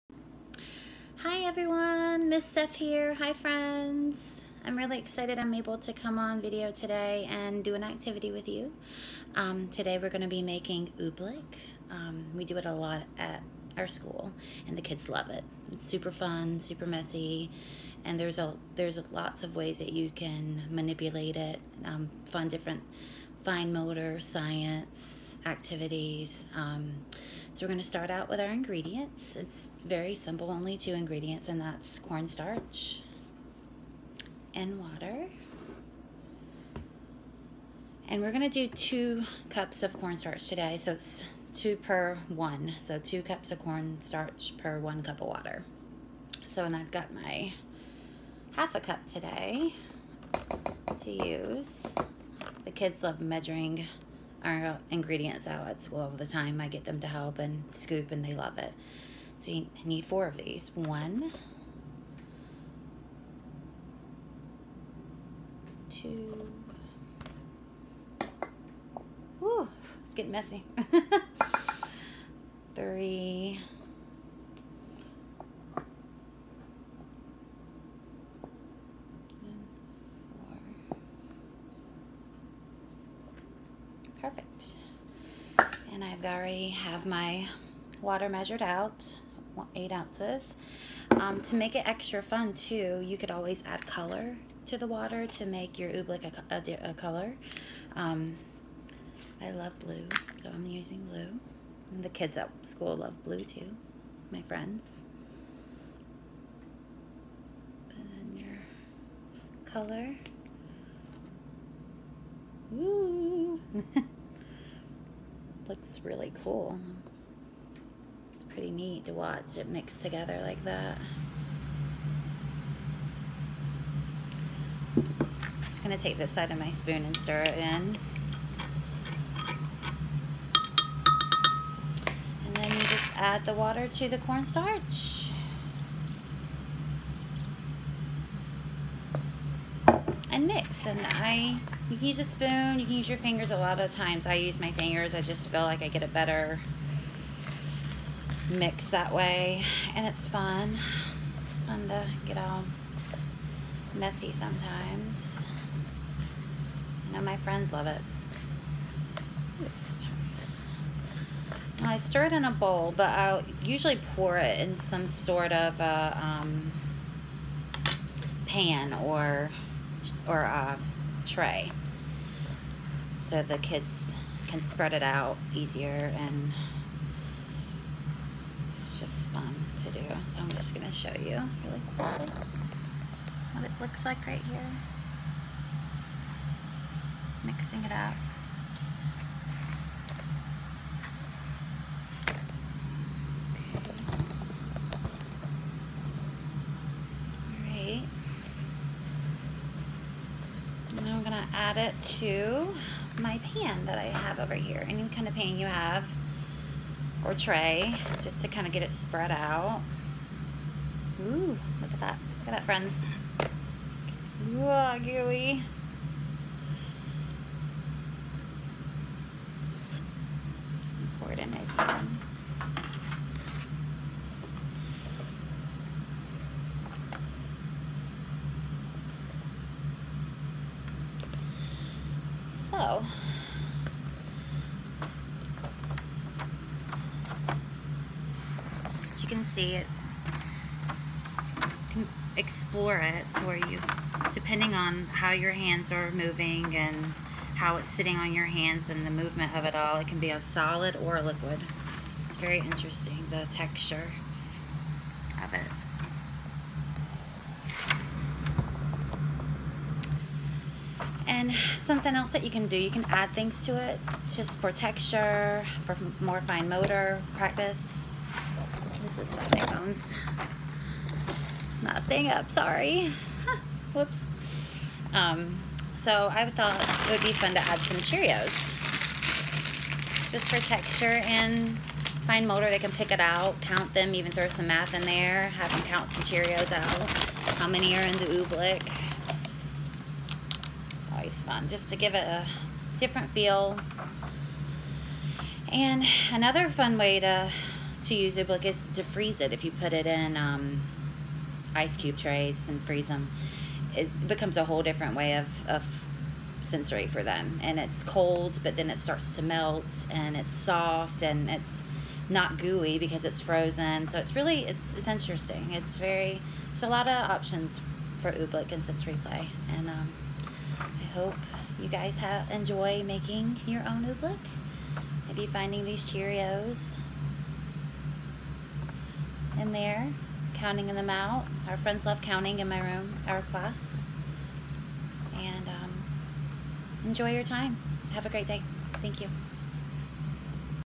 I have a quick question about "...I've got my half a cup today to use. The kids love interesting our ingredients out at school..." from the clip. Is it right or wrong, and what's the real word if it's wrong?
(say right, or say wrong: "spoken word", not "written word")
wrong: "measuring", not "interesting".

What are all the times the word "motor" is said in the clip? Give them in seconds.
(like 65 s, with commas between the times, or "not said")
23 s, 266 s, 282 s.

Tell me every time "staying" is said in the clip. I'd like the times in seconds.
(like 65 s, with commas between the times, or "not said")
272 s.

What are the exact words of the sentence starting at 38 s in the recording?
And we're going to do two cups of cornstarch today, so it's two per one.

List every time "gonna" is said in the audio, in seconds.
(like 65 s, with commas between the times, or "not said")
125 s, 180 s.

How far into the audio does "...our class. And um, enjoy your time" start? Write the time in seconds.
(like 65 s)
333 s.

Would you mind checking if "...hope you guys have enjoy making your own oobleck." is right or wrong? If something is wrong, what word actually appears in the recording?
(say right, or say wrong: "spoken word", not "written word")
right.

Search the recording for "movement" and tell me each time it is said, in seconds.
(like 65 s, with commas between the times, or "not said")
249 s.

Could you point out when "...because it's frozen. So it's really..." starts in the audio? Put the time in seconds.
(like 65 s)
312 s.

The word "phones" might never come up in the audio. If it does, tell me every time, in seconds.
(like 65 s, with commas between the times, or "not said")
269 s.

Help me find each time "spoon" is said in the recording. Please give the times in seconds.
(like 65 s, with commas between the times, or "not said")
126 s, 142 s.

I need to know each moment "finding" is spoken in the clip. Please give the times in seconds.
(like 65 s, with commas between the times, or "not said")
325 s.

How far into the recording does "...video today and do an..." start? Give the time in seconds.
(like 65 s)
6 s.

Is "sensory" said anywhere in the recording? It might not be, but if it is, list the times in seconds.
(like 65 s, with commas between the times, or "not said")
306 s, 318 s.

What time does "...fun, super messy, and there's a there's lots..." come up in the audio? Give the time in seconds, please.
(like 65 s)
16 s.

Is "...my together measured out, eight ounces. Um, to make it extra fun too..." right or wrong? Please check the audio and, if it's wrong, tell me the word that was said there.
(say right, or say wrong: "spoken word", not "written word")
wrong: "water", not "together".